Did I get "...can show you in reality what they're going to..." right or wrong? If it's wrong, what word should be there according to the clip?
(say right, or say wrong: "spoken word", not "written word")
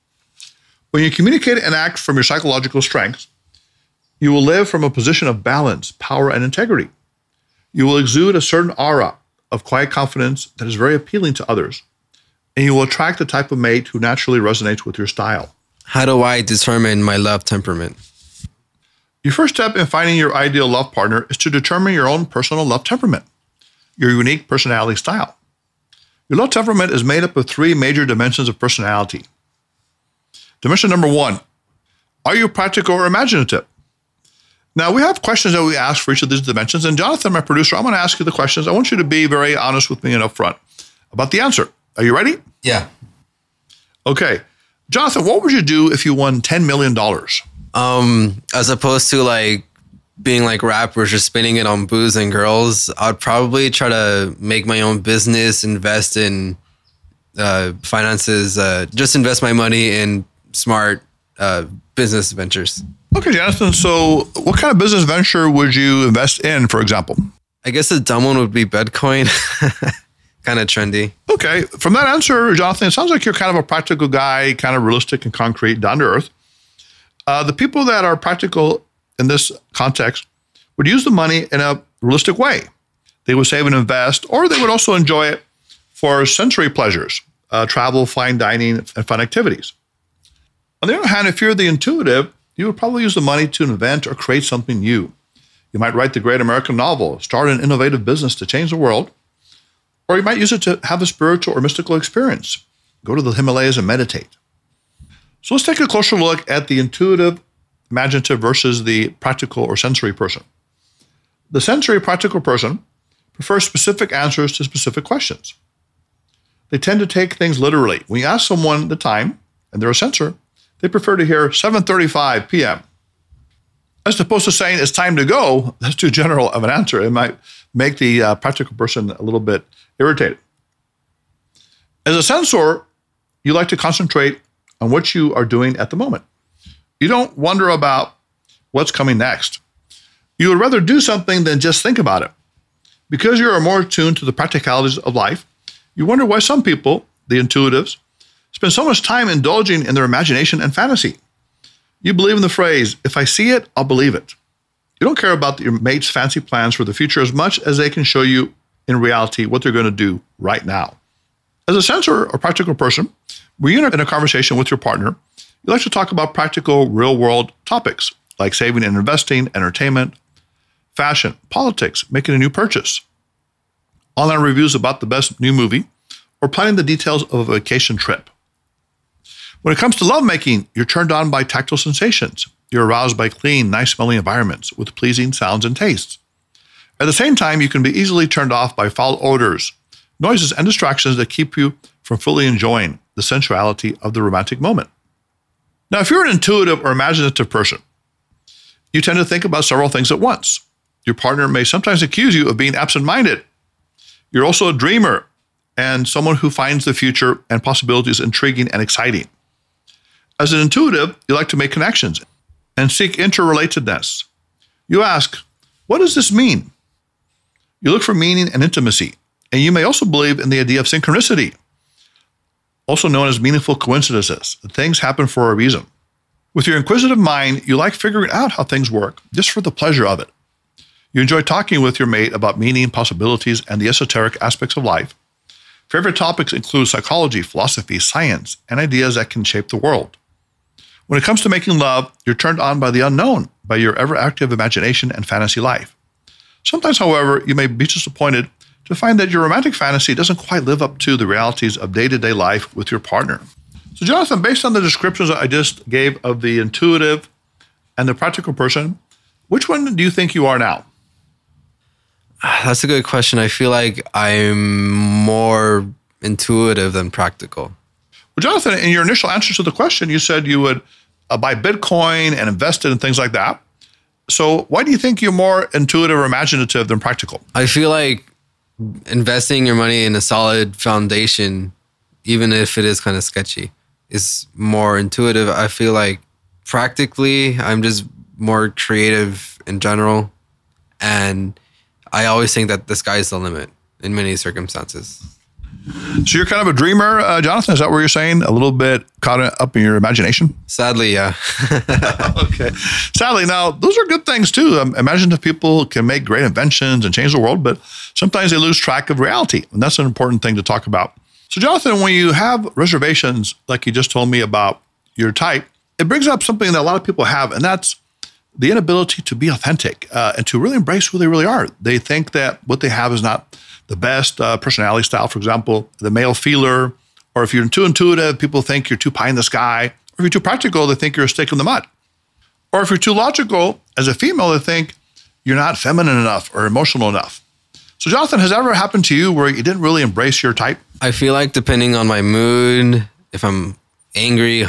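right.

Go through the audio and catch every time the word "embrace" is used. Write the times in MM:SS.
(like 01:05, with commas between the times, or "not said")
05:20, 05:40.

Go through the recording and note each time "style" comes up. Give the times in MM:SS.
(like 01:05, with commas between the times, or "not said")
00:15, 00:24, 05:25.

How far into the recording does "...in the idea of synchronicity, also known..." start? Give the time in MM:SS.
03:40.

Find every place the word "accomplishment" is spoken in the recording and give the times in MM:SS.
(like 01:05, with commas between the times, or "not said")
not said.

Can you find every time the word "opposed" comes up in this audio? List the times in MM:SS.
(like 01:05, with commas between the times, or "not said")
00:48, 02:04.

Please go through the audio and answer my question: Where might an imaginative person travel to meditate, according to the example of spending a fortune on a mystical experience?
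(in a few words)
The Himalayas.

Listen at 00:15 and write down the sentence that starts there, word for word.
How do I determine my love temperament?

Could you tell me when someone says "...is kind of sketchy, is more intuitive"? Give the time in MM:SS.
04:42.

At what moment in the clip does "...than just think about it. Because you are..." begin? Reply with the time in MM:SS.
02:21.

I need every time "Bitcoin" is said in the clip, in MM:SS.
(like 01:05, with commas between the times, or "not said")
01:08, 04:31.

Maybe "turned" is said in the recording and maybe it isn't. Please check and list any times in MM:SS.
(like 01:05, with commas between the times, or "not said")
03:00, 03:08, 04:02.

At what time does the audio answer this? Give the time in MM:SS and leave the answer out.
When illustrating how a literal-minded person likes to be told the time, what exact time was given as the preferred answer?
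02:01.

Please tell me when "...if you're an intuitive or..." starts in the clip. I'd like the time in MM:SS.
03:16.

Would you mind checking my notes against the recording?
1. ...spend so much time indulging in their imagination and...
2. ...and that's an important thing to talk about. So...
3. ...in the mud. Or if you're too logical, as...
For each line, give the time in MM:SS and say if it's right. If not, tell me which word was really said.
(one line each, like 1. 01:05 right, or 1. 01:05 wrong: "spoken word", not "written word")
1. 02:28 right
2. 05:09 right
3. 05:31 right.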